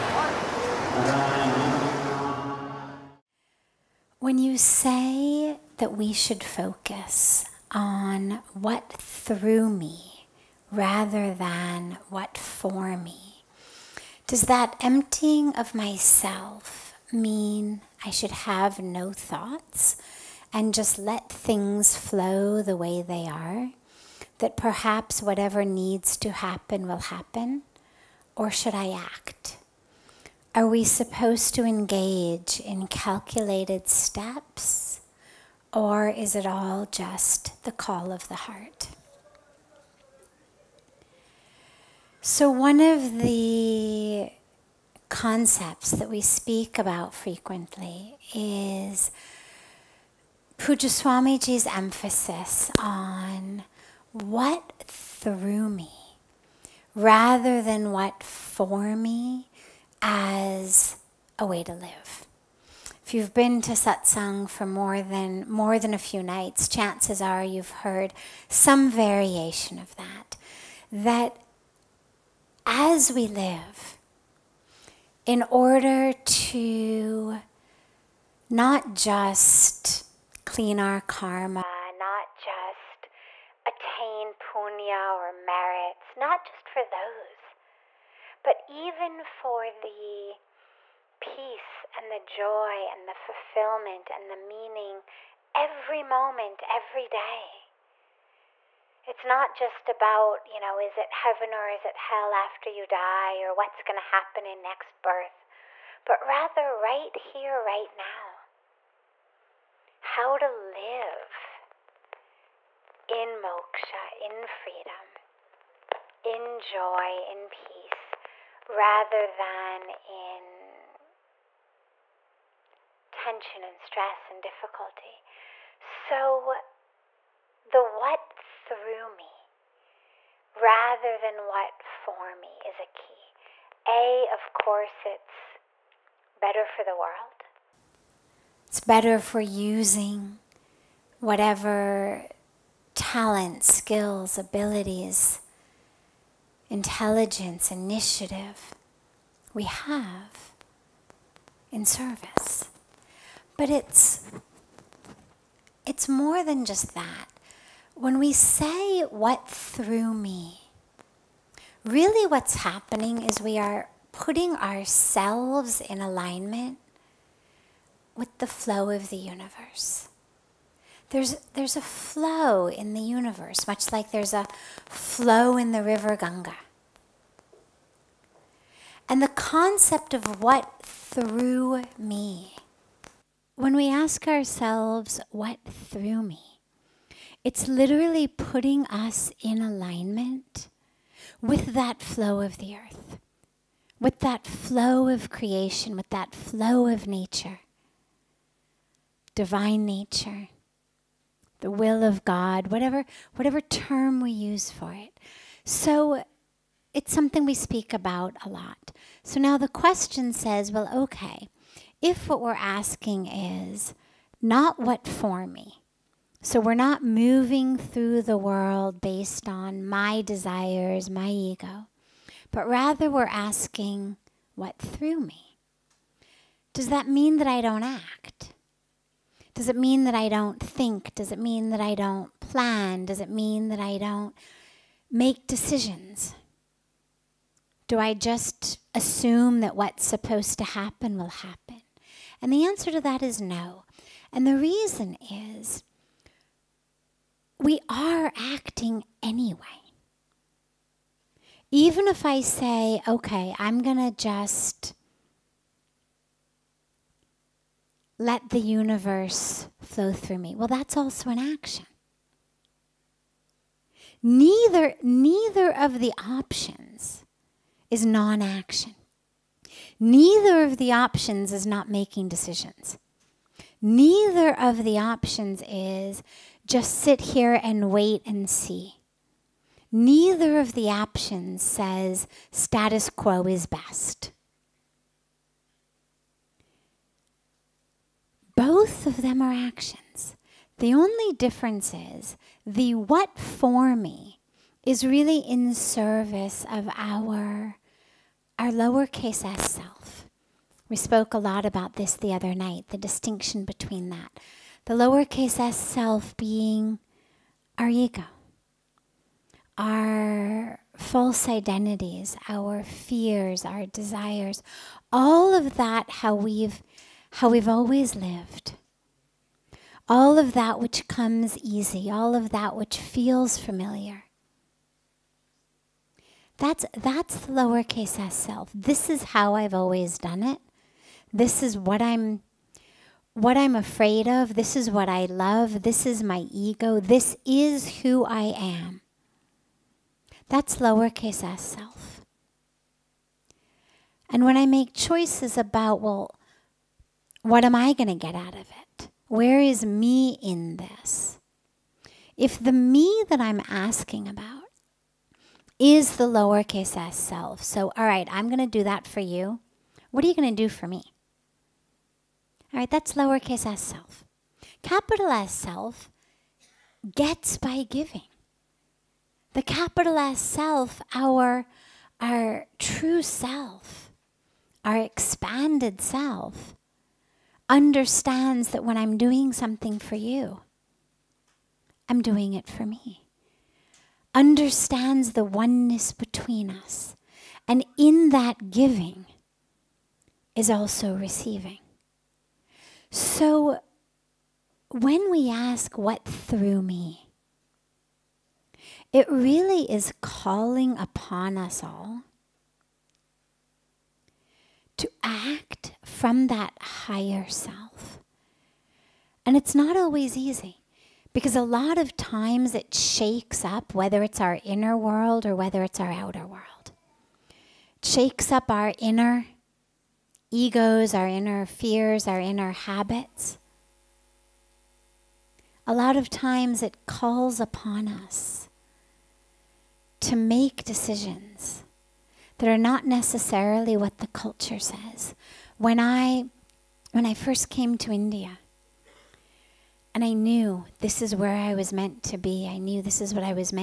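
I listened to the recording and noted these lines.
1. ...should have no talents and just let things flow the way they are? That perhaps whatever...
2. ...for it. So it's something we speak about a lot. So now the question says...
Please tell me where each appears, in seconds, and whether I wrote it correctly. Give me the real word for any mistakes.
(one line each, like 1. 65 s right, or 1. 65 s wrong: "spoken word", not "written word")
1. 18 s wrong: "thoughts", not "talents"
2. 204 s right.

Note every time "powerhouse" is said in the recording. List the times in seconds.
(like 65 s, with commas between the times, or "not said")
not said.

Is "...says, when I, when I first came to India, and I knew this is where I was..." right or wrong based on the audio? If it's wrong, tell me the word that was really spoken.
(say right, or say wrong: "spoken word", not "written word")
right.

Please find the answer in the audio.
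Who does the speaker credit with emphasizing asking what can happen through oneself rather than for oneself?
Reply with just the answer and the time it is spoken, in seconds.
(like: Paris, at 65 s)
Pujya Swamiji, at 50 s.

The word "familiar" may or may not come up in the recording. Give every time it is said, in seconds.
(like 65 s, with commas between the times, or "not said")
323 s.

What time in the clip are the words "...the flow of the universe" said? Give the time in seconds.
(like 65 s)
168 s.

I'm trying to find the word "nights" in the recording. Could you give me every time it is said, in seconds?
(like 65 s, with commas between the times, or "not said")
66 s, 302 s.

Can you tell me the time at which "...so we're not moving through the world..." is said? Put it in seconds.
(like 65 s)
216 s.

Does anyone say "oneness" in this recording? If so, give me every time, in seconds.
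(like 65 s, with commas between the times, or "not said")
385 s.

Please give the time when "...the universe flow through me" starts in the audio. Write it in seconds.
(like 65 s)
258 s.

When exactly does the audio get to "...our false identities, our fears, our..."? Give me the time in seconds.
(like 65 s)
309 s.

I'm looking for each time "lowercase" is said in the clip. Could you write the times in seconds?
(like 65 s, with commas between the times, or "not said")
298 s, 304 s, 327 s, 340 s, 356 s, 363 s.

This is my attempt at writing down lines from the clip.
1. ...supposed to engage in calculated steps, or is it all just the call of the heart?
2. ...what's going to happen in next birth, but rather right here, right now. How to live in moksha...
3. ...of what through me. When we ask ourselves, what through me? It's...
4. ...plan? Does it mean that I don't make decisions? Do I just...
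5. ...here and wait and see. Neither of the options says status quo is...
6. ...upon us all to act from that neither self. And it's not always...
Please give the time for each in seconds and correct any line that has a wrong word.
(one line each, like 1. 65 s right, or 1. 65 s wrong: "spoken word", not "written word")
1. 30 s right
2. 103 s right
3. 180 s right
4. 232 s right
5. 277 s right
6. 400 s wrong: "higher", not "neither".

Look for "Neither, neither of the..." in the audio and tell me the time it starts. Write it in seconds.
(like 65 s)
264 s.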